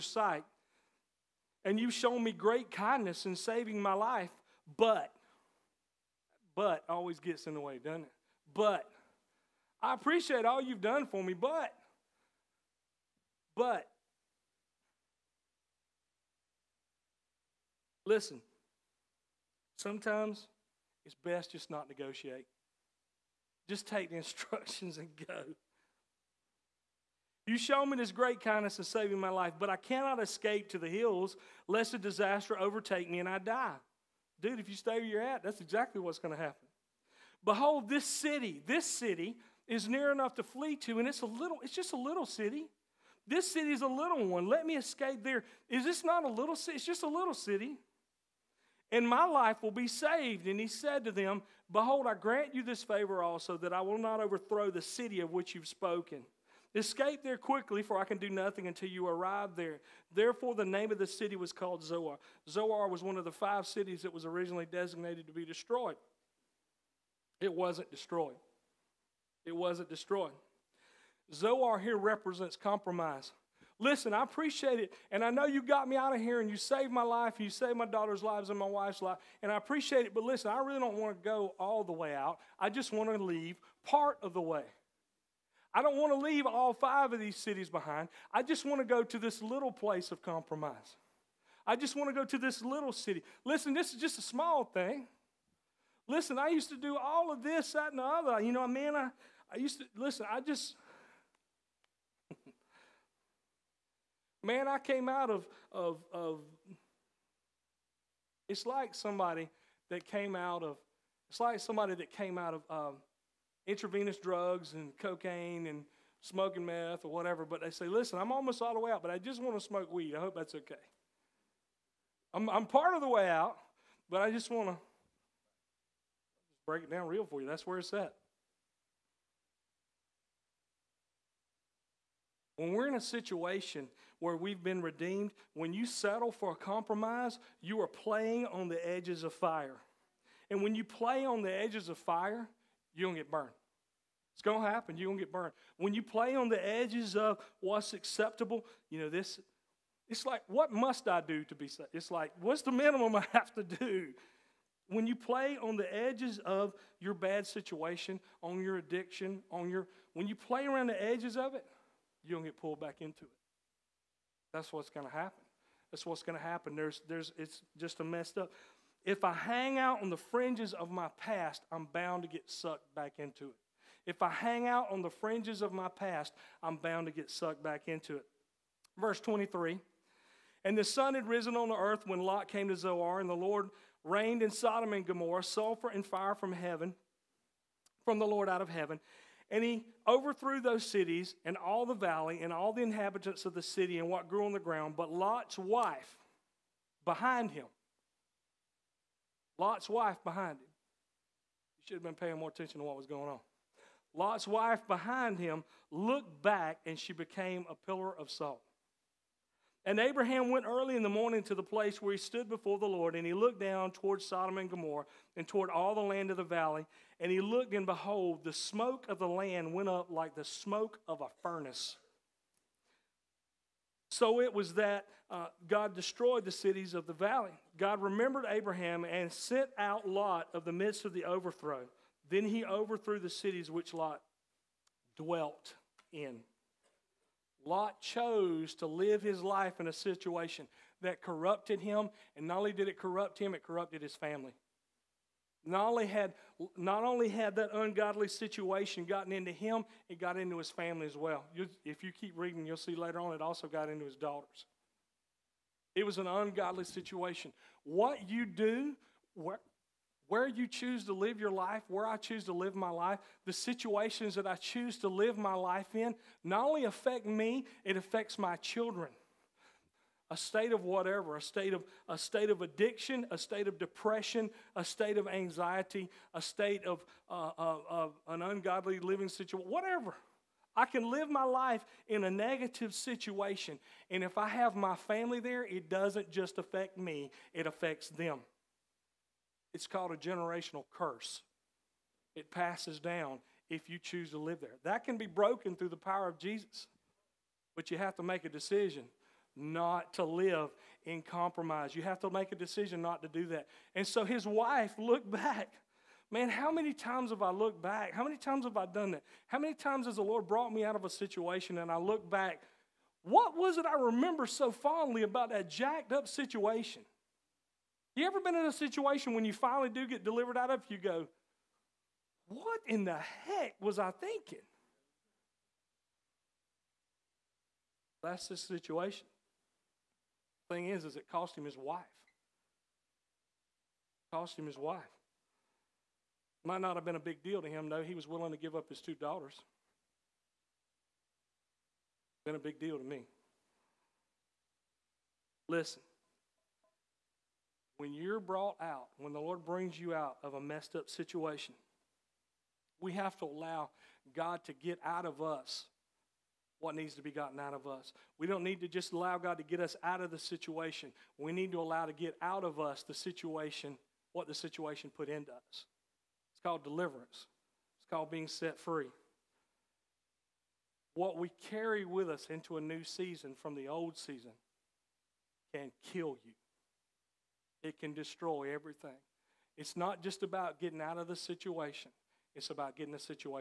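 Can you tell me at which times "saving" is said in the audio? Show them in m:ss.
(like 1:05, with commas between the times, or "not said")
0:03, 0:28.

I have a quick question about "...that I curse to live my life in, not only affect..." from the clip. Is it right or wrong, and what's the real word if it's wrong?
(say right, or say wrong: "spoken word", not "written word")
wrong: "choose", not "curse".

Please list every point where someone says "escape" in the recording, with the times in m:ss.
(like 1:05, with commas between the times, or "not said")
0:30, 0:44, 0:56.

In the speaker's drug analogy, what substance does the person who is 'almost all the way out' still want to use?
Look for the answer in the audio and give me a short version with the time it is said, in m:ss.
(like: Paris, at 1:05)
weed, at 1:59.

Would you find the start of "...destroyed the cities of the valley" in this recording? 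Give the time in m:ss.
3:45.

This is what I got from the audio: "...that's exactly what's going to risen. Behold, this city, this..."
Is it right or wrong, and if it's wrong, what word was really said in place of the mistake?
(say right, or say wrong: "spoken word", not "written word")
wrong: "happen", not "risen".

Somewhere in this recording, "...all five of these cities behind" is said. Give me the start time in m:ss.
1:26.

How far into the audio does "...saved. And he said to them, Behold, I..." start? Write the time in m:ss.
0:49.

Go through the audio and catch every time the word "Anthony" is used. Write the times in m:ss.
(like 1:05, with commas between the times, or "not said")
not said.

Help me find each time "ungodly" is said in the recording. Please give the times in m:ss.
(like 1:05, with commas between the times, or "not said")
4:07, 4:16, 4:38.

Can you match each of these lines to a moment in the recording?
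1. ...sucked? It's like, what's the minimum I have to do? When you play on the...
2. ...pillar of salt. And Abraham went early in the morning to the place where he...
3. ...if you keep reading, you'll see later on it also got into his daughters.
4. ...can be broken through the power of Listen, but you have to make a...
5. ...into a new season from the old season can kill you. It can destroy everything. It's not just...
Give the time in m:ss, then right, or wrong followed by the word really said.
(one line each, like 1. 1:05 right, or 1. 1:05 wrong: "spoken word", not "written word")
1. 2:31 wrong: "saved", not "sucked"
2. 3:27 right
3. 4:11 right
4. 4:55 wrong: "Jesus", not "Listen"
5. 6:12 right.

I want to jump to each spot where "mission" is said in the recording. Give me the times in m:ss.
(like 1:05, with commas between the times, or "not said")
not said.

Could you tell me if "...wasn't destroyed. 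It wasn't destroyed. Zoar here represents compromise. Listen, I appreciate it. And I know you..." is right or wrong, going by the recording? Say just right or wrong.
right.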